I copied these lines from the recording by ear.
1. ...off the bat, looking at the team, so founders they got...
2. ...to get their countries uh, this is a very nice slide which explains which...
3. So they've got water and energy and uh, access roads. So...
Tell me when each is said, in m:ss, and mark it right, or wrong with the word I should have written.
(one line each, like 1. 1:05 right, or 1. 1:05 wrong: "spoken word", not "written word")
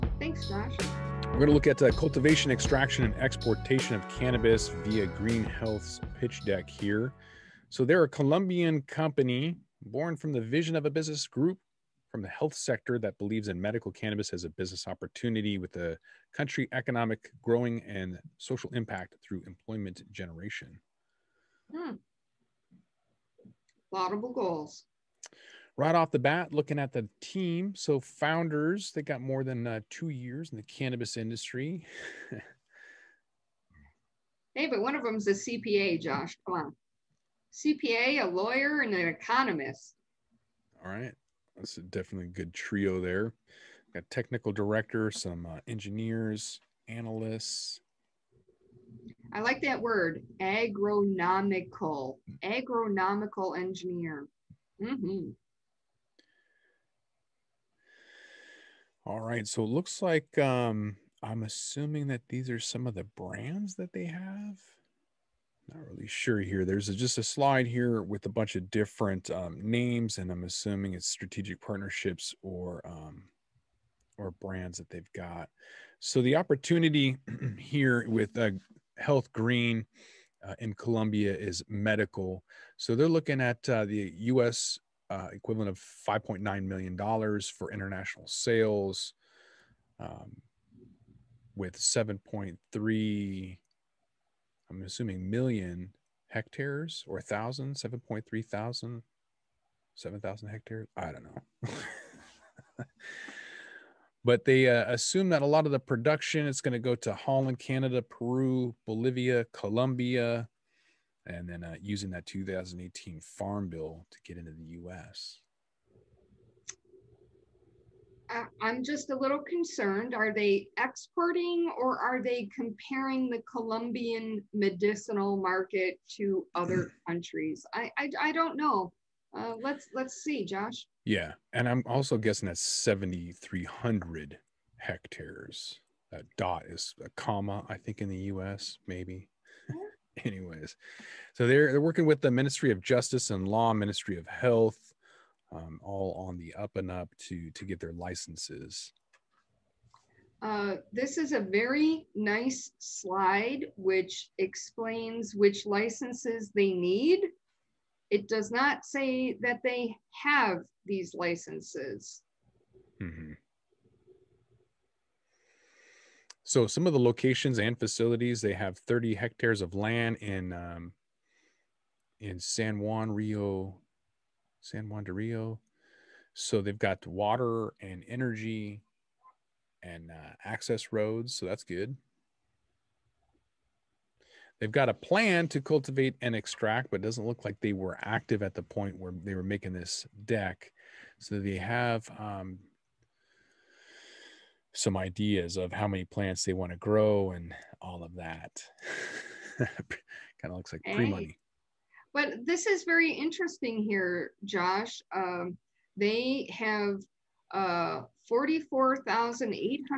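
1. 0:25 right
2. 2:27 wrong: "licenses", not "countries"
3. 2:56 right.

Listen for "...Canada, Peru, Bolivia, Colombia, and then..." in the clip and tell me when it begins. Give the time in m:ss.
1:47.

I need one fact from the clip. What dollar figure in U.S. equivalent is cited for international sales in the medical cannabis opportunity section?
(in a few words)
5.9 million dollars.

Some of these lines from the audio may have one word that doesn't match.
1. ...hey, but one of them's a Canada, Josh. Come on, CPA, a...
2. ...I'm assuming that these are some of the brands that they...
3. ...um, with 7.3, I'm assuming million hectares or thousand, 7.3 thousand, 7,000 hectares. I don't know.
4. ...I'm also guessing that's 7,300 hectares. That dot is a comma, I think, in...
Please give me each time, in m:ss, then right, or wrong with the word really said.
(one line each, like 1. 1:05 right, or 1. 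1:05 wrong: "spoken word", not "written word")
1. 0:34 wrong: "CPA", not "Canada"
2. 1:01 right
3. 1:29 right
4. 2:11 right.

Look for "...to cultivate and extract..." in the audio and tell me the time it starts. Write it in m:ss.
3:05.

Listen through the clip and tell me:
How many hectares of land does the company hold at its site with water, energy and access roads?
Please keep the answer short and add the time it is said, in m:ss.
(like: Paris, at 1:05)
30 hectares, at 2:48.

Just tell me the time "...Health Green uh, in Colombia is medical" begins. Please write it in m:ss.
1:18.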